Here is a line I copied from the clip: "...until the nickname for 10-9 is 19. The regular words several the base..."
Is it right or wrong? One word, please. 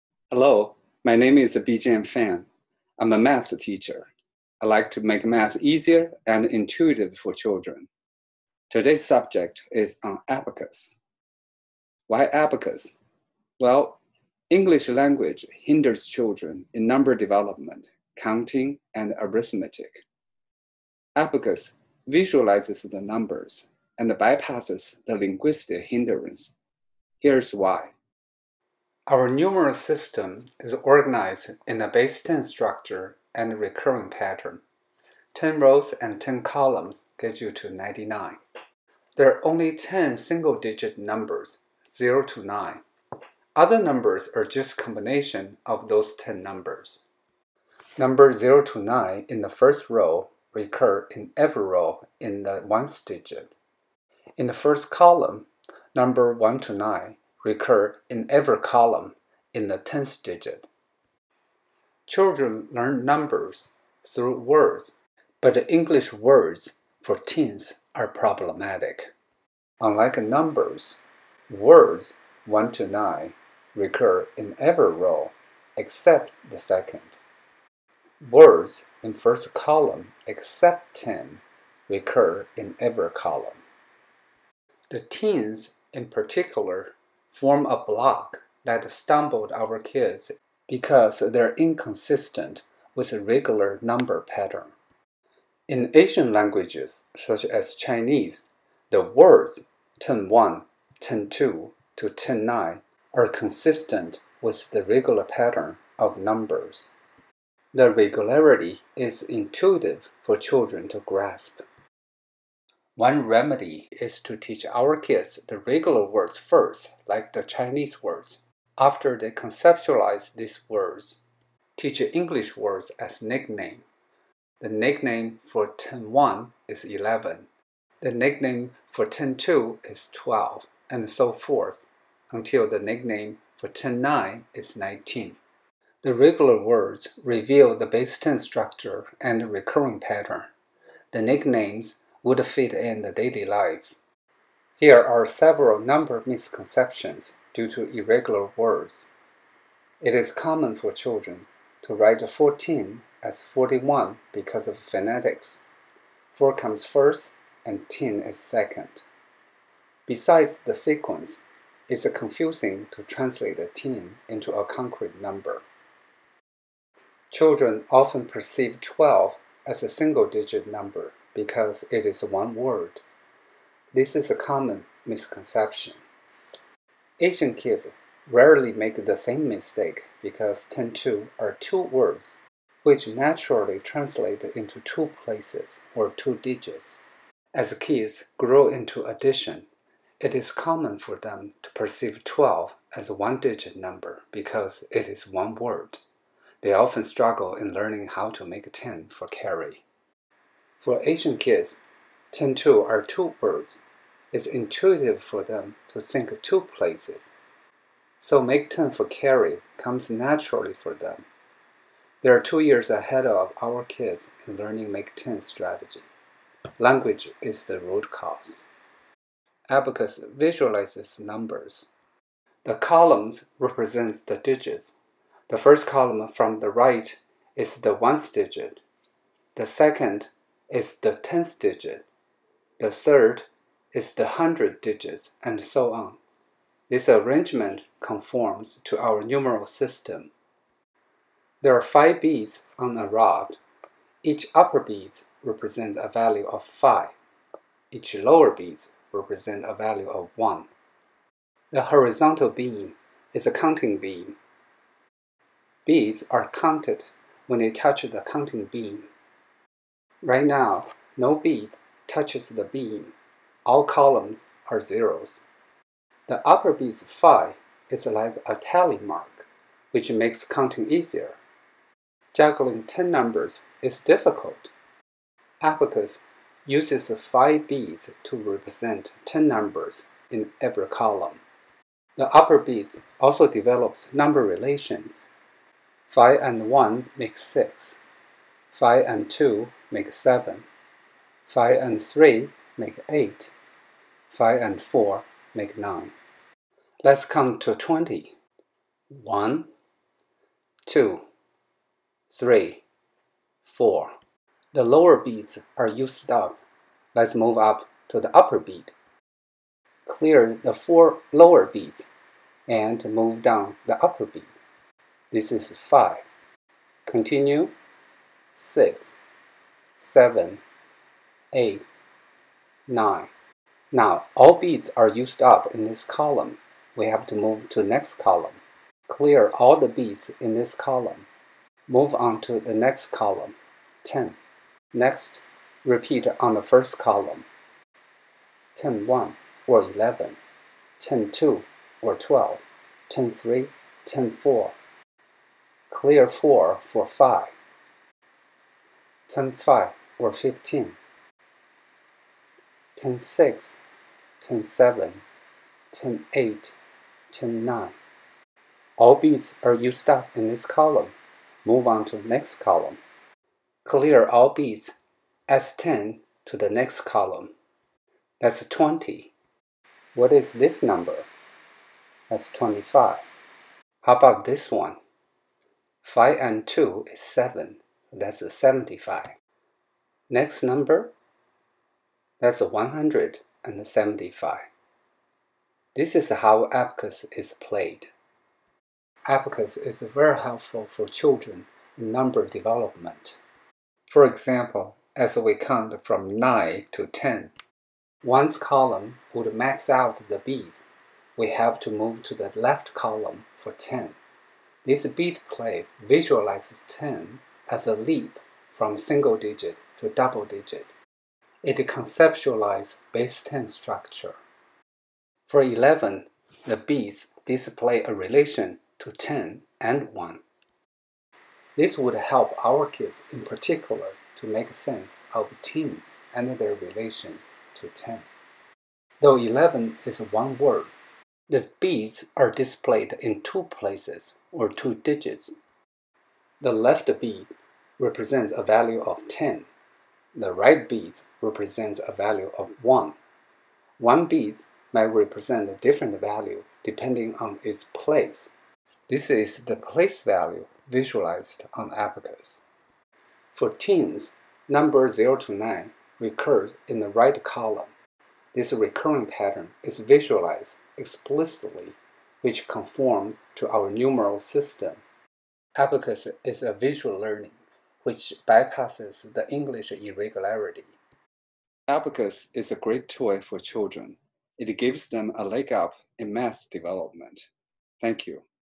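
wrong.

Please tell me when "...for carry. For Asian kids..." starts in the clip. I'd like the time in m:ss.
3:19.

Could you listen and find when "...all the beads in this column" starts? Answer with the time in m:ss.
5:29.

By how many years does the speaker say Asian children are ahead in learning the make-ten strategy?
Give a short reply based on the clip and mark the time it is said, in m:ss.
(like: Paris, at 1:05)
2, at 3:32.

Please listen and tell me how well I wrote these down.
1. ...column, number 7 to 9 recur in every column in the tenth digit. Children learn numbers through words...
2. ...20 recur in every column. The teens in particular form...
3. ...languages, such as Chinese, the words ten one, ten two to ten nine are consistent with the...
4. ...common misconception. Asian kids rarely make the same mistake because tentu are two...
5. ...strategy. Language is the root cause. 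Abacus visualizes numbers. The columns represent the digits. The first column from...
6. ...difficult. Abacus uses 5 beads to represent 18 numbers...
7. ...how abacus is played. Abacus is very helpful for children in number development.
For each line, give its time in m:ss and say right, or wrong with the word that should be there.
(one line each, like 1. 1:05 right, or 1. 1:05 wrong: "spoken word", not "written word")
1. 0:54 wrong: "1", not "7"
2. 1:20 wrong: "10", not "20"
3. 1:36 right
4. 2:54 right
5. 3:35 right
6. 4:33 wrong: "10", not "18"
7. 6:26 right.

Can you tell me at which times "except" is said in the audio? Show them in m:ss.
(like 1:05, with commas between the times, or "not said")
1:15, 1:20.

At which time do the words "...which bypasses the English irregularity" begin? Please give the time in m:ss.
7:48.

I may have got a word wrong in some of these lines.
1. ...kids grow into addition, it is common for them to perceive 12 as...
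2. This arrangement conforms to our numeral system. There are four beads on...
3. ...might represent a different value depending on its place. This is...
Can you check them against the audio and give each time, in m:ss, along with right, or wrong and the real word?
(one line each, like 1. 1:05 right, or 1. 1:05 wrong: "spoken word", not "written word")
1. 3:07 right
2. 3:56 wrong: "five", not "four"
3. 7:24 right.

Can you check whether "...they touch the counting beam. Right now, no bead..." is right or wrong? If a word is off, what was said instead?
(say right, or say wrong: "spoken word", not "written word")
right.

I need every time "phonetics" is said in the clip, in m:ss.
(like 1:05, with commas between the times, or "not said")
2:34.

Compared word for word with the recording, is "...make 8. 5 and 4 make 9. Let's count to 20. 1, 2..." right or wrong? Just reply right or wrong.
right.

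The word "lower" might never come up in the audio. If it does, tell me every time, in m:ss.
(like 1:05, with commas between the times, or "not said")
4:08, 5:04, 5:11.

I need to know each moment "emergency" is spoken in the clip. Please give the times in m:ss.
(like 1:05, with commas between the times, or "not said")
not said.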